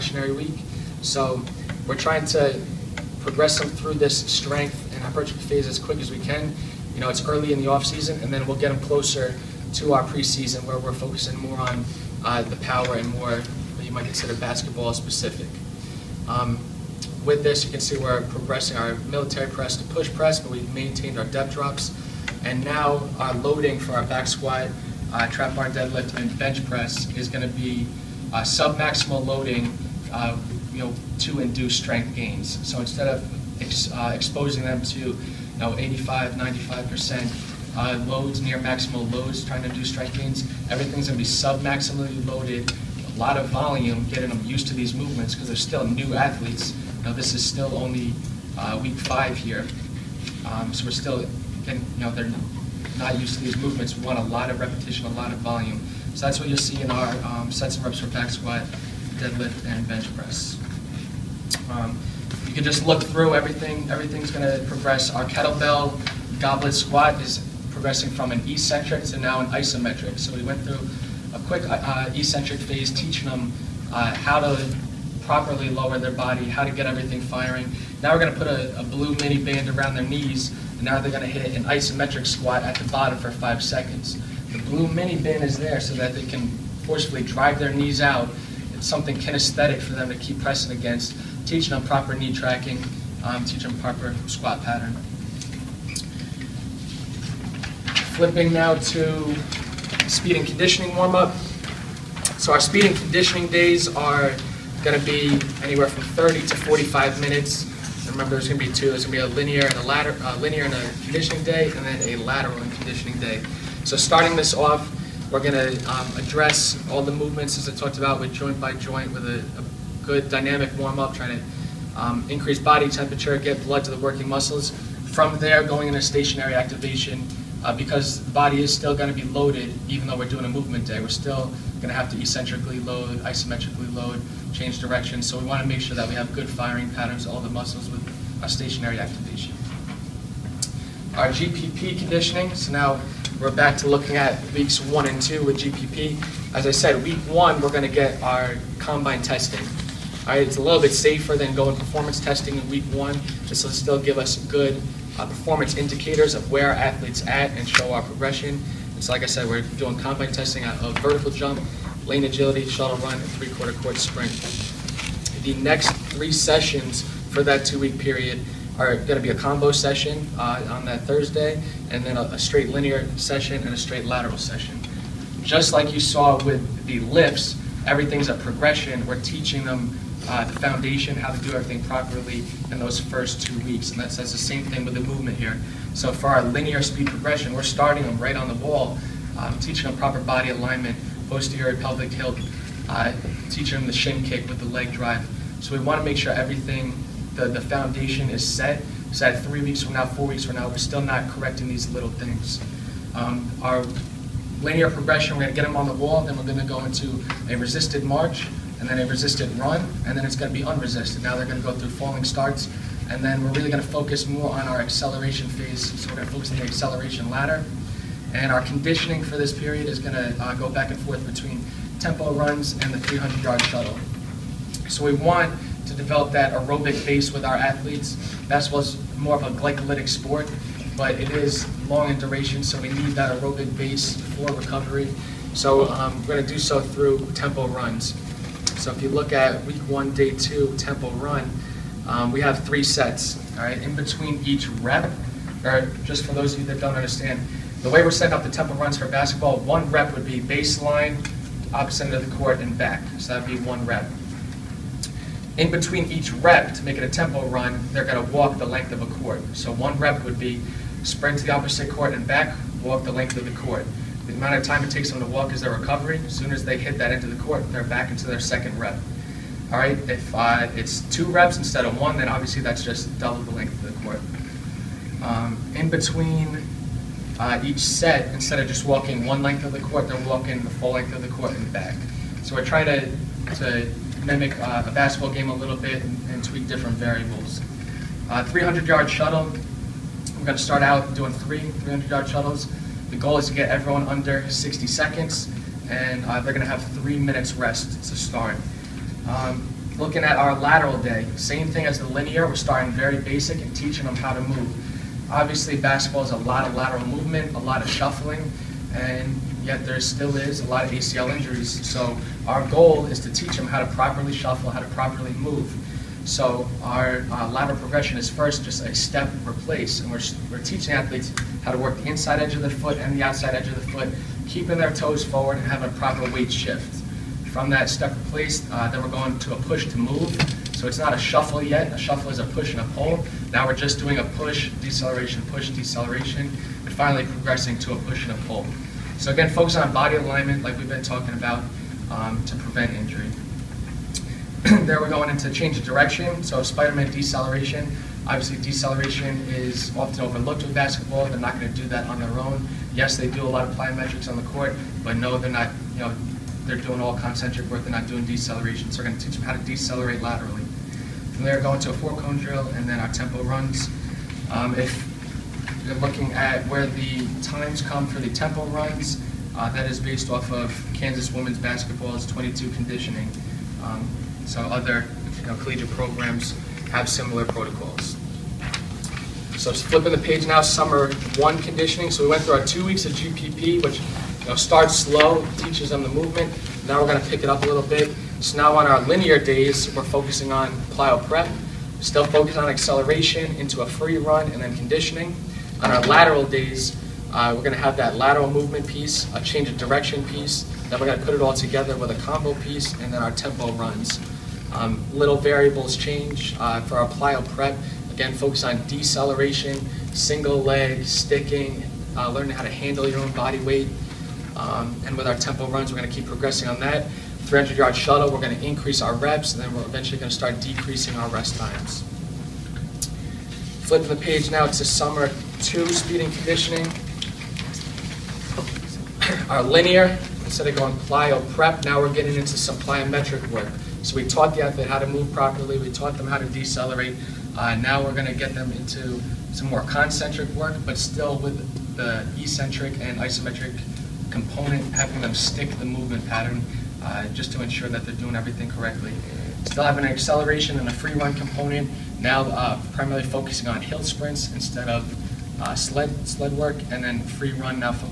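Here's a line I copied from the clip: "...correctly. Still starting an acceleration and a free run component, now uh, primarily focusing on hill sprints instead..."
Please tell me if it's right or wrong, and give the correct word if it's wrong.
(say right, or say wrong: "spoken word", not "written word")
wrong: "having", not "starting".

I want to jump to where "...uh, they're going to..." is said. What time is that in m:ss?
4:56.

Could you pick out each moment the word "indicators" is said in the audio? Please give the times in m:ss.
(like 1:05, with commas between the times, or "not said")
2:35.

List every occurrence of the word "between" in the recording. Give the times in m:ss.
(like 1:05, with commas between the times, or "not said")
3:41, 4:03, 4:15, 4:35.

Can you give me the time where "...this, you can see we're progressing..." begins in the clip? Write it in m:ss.
0:17.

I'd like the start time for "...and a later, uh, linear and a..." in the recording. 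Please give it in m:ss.
1:49.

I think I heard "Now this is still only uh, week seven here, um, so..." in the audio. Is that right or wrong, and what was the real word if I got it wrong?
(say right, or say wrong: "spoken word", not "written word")
wrong: "five", not "seven".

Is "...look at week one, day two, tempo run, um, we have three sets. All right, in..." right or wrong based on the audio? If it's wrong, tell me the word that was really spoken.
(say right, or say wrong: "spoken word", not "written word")
right.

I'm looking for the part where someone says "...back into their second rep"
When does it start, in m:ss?
4:27.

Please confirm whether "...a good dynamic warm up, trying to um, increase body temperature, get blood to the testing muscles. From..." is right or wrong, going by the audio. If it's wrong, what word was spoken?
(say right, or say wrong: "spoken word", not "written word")
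wrong: "working", not "testing".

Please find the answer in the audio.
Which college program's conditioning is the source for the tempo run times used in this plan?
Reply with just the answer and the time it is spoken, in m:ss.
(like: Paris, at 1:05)
Kansas women's basketball, at 6:10.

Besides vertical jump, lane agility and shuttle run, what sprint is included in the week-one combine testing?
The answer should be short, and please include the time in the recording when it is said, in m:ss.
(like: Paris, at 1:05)
three-quarter court sprint, at 2:43.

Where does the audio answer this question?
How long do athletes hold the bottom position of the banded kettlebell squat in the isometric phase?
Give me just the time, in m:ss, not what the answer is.
1:23.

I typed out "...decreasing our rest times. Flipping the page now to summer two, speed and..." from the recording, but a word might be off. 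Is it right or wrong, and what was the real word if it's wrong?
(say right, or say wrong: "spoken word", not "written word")
right.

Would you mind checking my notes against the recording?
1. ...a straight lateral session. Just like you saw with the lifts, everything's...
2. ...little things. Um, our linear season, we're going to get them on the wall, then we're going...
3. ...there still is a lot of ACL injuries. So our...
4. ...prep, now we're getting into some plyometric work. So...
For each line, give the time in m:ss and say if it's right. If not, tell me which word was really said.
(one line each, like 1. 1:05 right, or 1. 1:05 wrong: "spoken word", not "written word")
1. 2:53 right
2. 3:21 wrong: "progression", not "season"
3. 5:09 right
4. 7:11 right.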